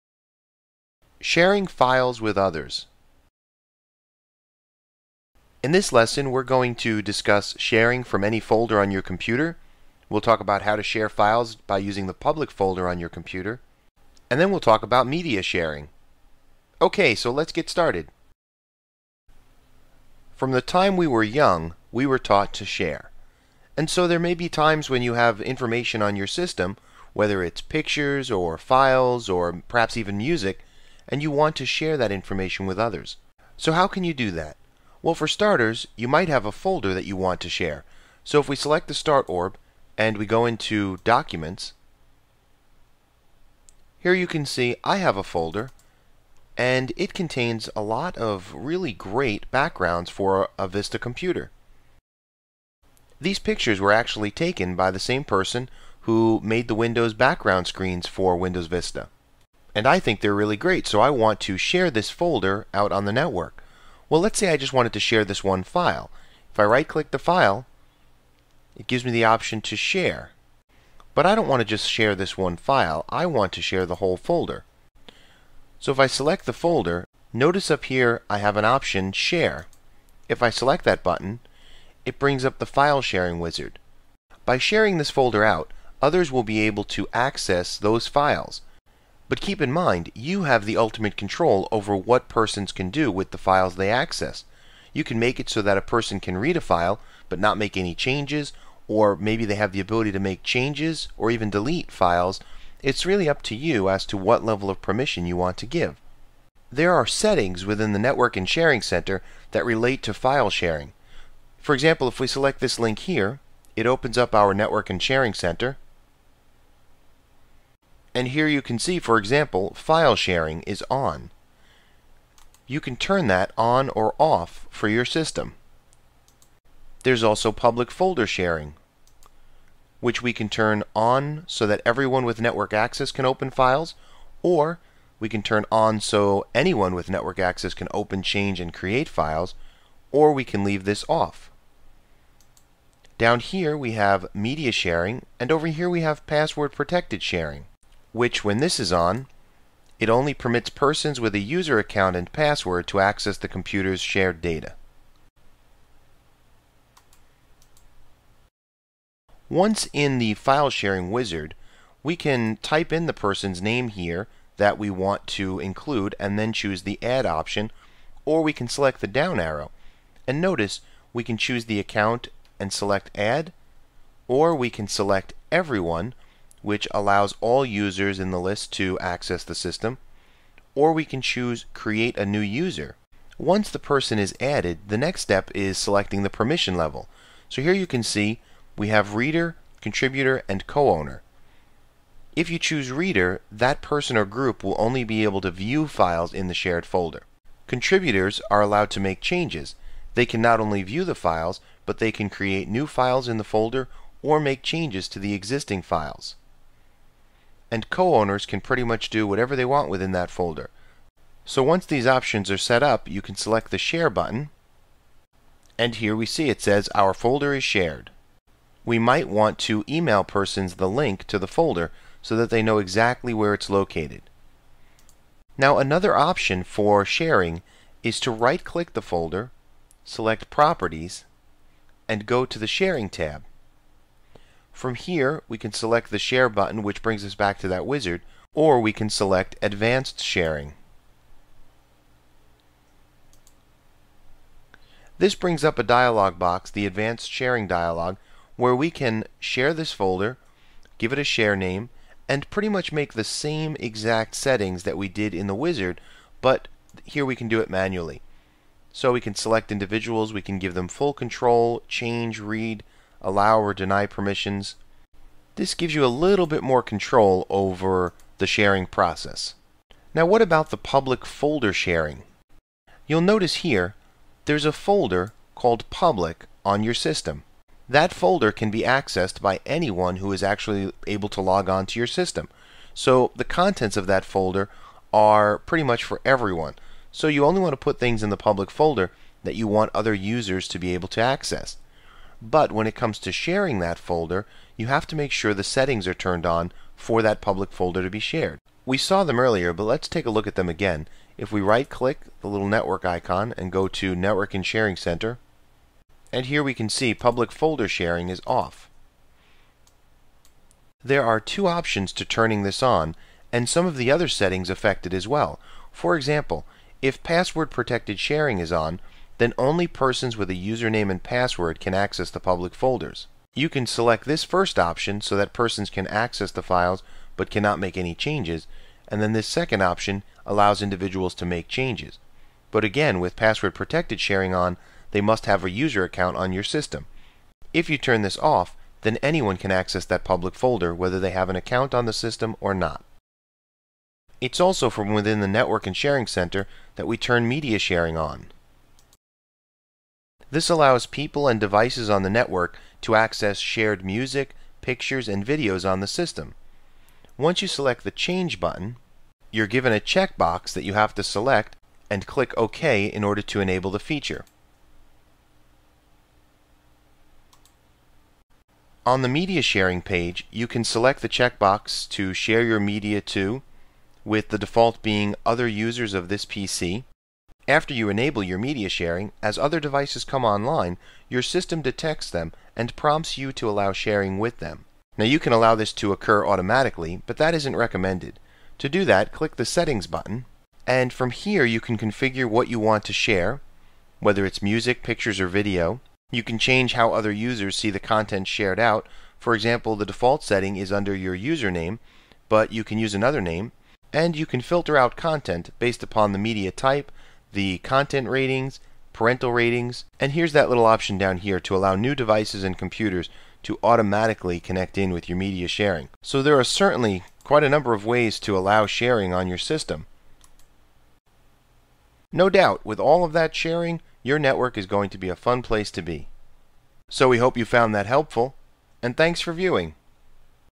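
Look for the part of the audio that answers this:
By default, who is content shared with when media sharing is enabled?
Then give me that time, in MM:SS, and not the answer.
06:15.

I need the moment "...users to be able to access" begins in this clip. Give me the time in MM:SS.
04:50.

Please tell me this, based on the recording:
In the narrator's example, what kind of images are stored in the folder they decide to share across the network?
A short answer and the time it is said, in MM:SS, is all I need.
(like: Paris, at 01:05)
Backgrounds, at 00:49.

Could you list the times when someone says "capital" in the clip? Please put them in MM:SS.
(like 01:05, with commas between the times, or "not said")
not said.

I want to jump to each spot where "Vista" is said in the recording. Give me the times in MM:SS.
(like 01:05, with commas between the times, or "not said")
00:50, 00:58.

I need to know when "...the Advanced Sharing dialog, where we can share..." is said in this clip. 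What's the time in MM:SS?
04:06.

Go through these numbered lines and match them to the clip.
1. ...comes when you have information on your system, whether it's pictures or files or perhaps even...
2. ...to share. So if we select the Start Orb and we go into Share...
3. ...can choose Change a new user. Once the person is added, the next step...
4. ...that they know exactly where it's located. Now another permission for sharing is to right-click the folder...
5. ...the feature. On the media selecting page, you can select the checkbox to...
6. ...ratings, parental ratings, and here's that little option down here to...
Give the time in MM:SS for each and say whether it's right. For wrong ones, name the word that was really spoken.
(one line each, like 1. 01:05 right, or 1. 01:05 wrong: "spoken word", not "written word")
1. 00:24 wrong: "times", not "comes"
2. 00:37 wrong: "Documents", not "Share"
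3. 03:01 wrong: "Create", not "Change"
4. 03:42 wrong: "option", not "permission"
5. 06:03 wrong: "sharing", not "selecting"
6. 06:48 right.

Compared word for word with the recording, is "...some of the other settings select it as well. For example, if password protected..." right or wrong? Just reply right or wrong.
wrong.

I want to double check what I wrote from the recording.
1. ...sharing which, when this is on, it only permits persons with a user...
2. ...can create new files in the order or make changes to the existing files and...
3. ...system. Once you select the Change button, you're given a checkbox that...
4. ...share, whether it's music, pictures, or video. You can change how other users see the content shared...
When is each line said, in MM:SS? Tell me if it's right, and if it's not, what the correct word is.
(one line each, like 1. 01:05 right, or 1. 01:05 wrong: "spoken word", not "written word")
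1. 02:27 right
2. 03:22 wrong: "folder", not "order"
3. 05:56 right
4. 06:33 right.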